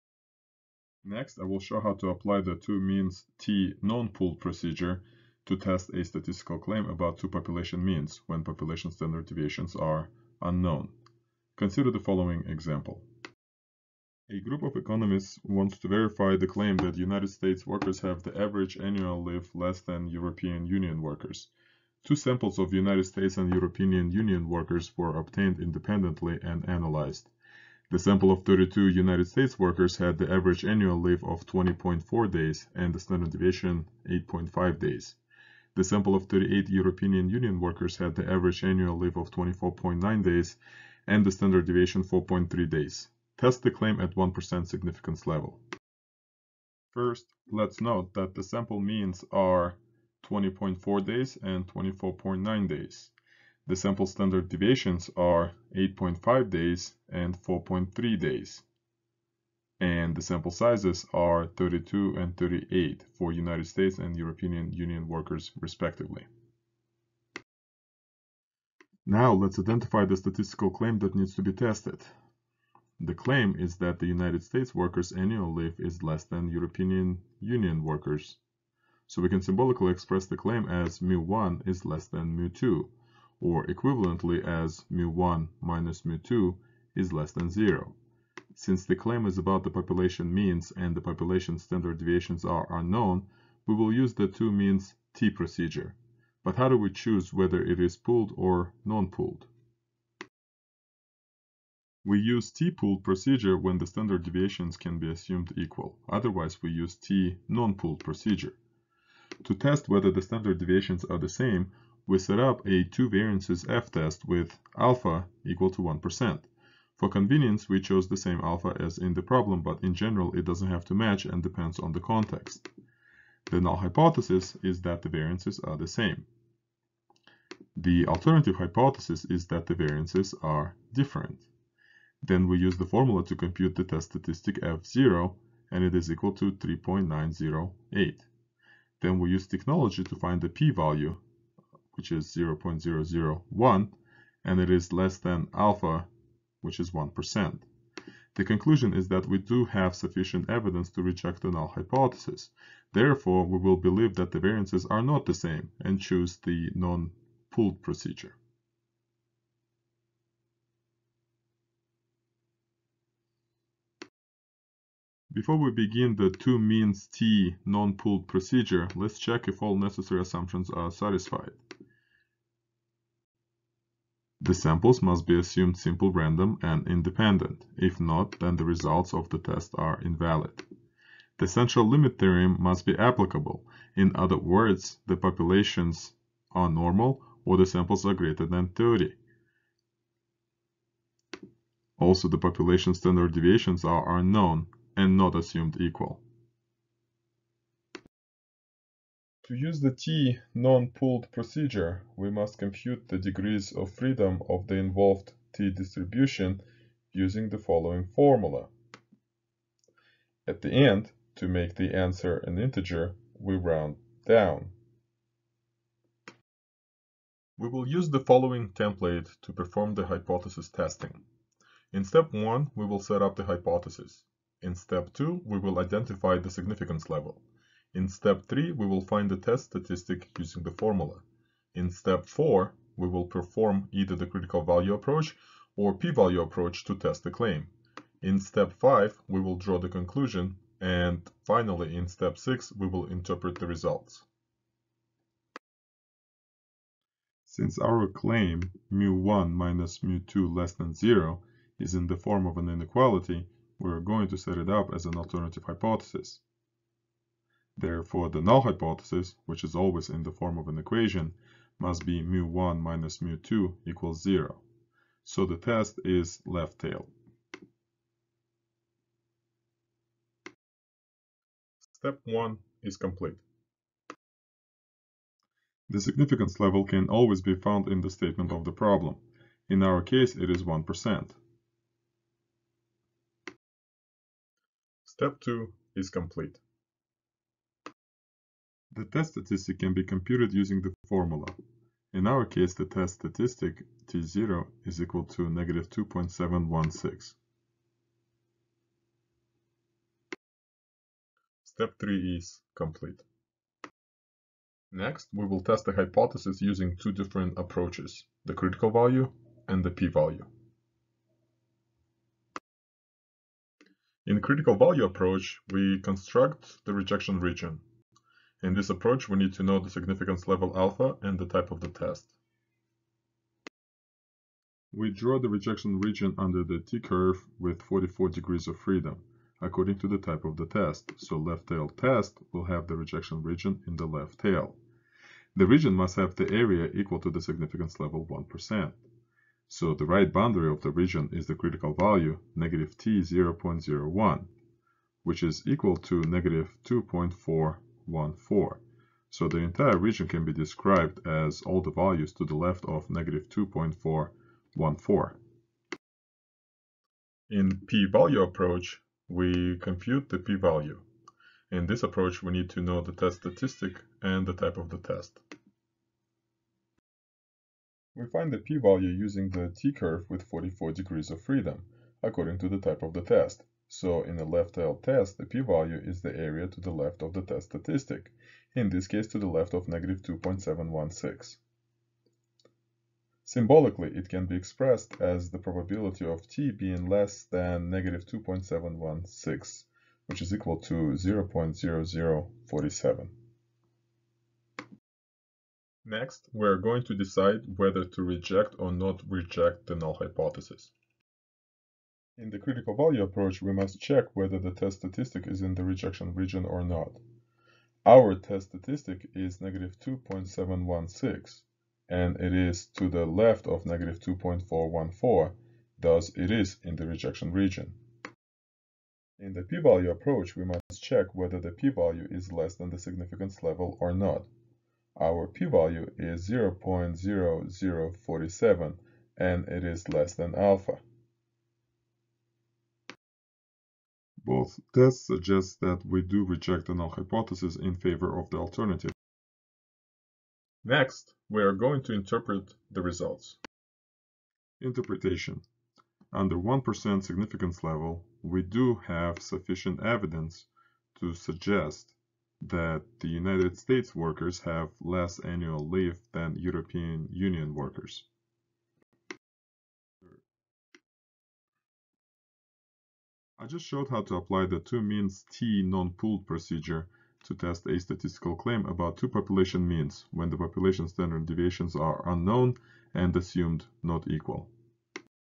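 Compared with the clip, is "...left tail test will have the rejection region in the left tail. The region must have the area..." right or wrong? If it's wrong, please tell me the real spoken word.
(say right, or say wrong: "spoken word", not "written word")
right.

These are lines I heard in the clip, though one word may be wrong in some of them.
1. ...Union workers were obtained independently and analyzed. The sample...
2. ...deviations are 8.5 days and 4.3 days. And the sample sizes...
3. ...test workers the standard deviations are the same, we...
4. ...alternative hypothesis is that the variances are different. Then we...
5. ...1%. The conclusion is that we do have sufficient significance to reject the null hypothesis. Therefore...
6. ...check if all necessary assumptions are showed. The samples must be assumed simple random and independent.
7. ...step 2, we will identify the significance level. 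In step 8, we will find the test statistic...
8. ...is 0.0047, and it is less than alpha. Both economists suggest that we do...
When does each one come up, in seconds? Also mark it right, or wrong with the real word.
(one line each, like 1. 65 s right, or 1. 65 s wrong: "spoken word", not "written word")
1. 24 s right
2. 54 s right
3. 109 s wrong: "whether", not "workers"
4. 128 s right
5. 146 s wrong: "evidence", not "significance"
6. 169 s wrong: "satisfied", not "showed"
7. 224 s wrong: "3", not "8"
8. 426 s wrong: "tests", not "economists".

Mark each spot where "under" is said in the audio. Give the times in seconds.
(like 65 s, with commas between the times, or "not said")
326 s, 446 s.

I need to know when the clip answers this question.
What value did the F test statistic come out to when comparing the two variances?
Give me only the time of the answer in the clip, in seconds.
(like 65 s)
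136 s.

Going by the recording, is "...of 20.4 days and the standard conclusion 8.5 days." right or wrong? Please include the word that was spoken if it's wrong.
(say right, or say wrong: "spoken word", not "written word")
wrong: "deviation", not "conclusion".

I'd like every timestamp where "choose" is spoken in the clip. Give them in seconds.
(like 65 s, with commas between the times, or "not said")
96 s, 156 s.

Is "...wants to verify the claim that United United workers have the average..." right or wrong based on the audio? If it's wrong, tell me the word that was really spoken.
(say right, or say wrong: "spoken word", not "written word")
wrong: "States", not "United".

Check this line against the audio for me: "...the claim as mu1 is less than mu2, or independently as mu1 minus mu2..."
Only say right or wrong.
wrong.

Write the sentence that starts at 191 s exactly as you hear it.
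Also, the population standard deviations are unknown and not assumed equal.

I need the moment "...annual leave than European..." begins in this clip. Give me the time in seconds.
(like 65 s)
455 s.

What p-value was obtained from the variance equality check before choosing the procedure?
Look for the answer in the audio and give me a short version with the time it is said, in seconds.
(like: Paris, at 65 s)
0.001, at 142 s.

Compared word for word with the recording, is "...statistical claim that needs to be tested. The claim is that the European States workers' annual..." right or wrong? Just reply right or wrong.
wrong.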